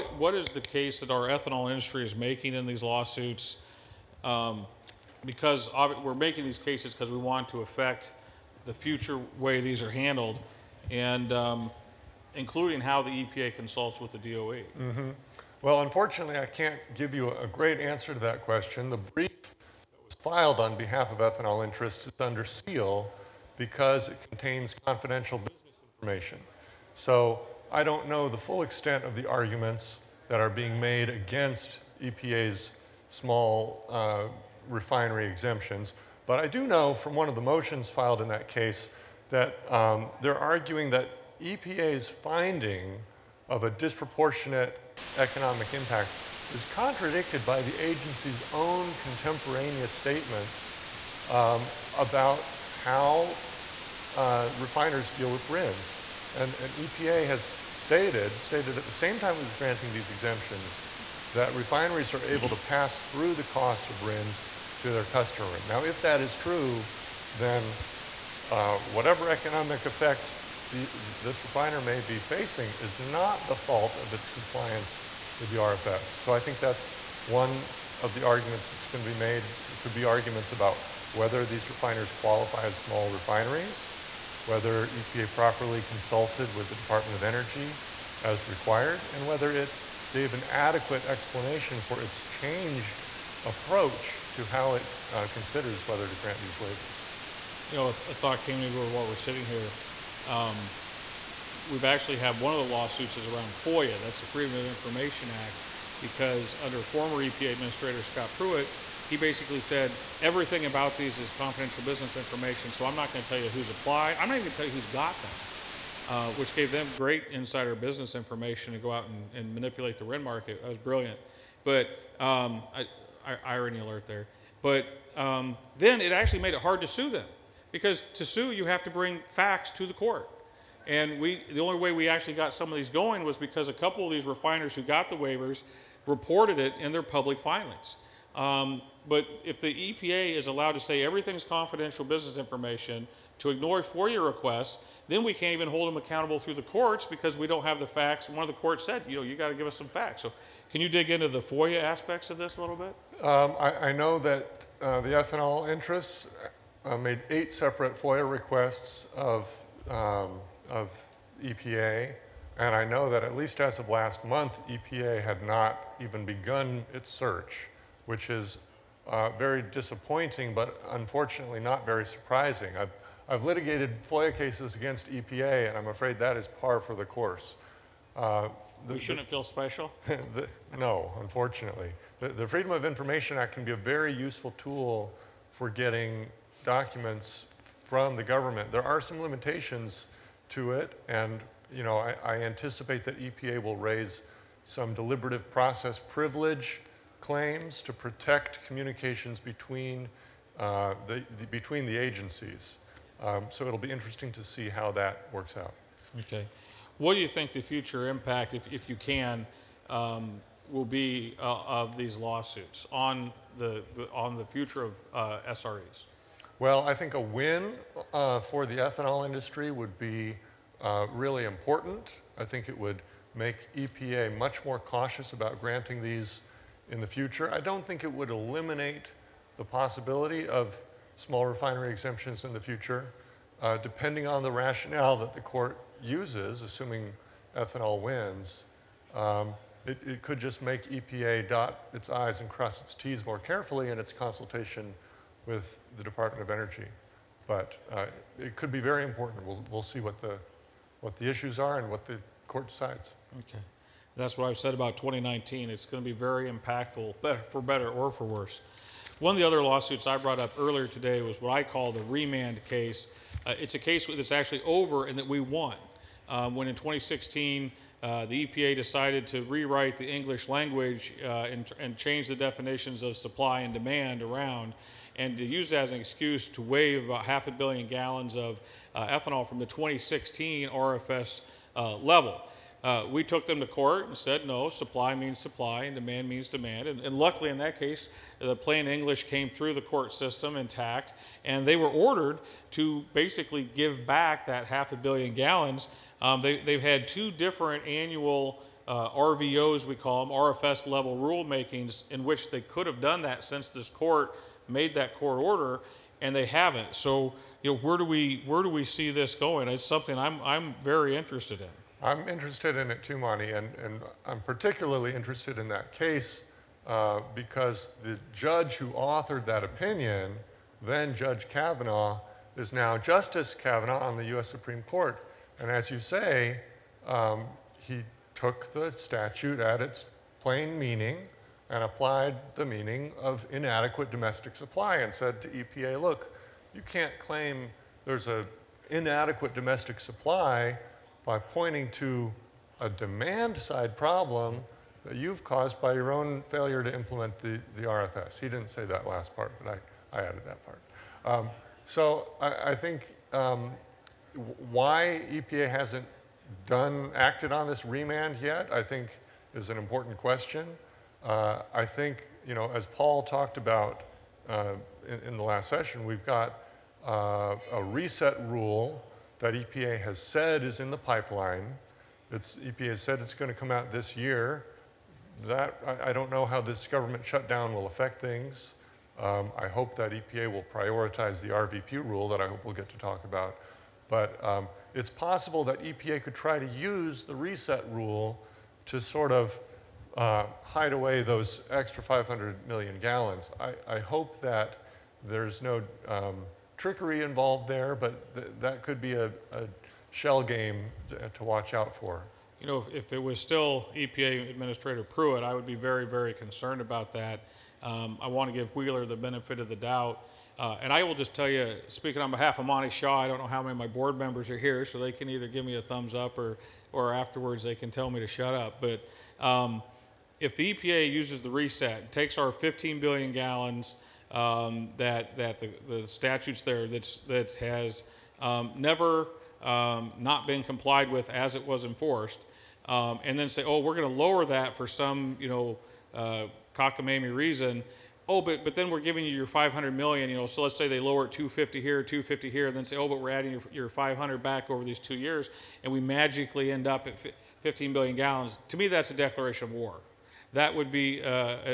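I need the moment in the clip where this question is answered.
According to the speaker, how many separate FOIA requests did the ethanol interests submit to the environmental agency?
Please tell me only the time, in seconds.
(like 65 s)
157 s.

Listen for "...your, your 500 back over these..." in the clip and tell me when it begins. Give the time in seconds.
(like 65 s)
443 s.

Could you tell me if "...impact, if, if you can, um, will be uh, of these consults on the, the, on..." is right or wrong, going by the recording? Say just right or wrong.
wrong.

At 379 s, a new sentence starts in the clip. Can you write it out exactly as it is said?
Um, I hope that EPA will prioritize the RVP rule that I hope we'll get to talk about.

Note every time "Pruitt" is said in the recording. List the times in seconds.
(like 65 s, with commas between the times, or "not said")
108 s, 405 s.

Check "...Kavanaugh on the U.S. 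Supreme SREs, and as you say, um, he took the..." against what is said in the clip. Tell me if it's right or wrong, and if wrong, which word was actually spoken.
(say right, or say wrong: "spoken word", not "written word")
wrong: "Court", not "SREs".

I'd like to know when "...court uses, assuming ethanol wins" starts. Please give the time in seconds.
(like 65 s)
235 s.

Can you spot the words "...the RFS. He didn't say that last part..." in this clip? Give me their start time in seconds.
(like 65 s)
347 s.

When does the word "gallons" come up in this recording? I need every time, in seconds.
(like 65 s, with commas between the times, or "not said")
277 s, 295 s, 392 s, 423 s, 448 s.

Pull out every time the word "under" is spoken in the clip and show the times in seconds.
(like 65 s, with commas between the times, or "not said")
22 s, 106 s.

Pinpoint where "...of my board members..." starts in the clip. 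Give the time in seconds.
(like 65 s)
413 s.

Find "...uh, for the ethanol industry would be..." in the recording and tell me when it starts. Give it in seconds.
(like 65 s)
218 s.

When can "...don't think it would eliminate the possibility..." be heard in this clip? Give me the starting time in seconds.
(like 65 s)
227 s.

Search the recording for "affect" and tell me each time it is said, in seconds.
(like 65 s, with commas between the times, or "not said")
7 s, 377 s.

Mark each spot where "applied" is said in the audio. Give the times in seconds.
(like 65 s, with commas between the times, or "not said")
113 s, 331 s.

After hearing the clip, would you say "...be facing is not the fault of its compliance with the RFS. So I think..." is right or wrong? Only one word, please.
right.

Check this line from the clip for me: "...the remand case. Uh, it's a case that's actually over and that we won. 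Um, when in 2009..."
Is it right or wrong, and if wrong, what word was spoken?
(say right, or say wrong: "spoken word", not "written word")
wrong: "2016", not "2009".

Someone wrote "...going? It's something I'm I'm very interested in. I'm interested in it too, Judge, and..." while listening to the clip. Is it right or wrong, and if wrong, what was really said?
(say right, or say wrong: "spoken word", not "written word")
wrong: "Monte", not "Judge".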